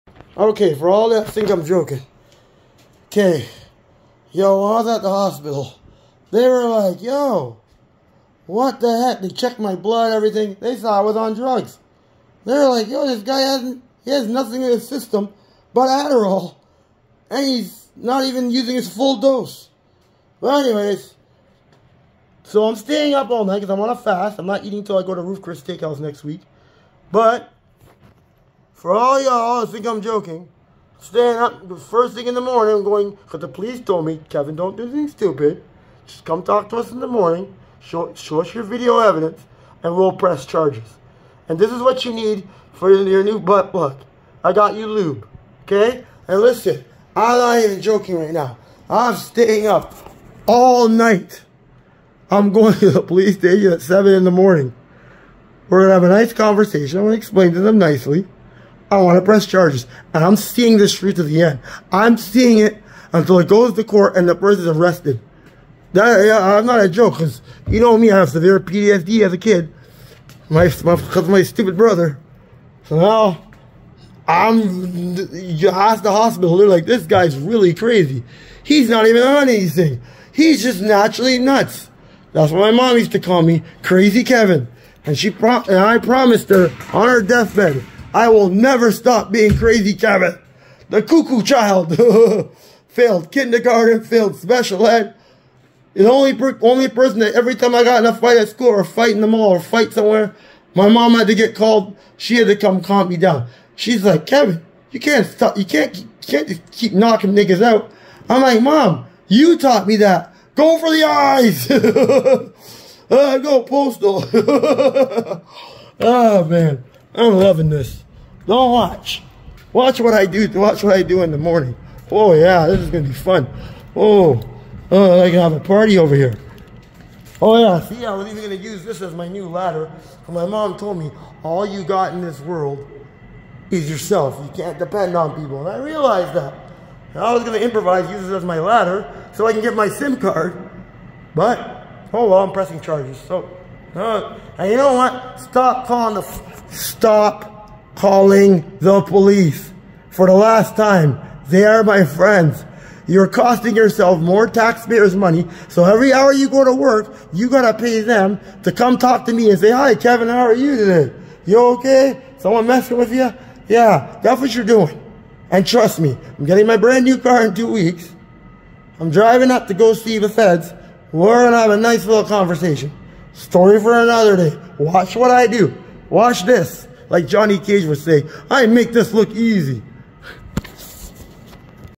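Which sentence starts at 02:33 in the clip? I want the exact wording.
You're costing yourself more taxpayers' money.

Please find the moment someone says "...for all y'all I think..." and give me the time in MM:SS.
00:28.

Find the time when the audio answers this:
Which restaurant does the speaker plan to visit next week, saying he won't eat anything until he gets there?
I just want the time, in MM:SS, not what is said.
00:25.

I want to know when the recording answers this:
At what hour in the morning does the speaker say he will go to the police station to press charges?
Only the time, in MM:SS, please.
00:53.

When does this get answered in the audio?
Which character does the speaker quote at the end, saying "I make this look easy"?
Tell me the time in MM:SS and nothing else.
02:57.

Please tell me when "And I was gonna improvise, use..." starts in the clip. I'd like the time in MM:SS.
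02:17.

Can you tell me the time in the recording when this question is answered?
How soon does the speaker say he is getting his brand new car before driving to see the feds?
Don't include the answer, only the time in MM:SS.
02:47.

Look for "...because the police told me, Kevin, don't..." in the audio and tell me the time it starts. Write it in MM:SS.
00:33.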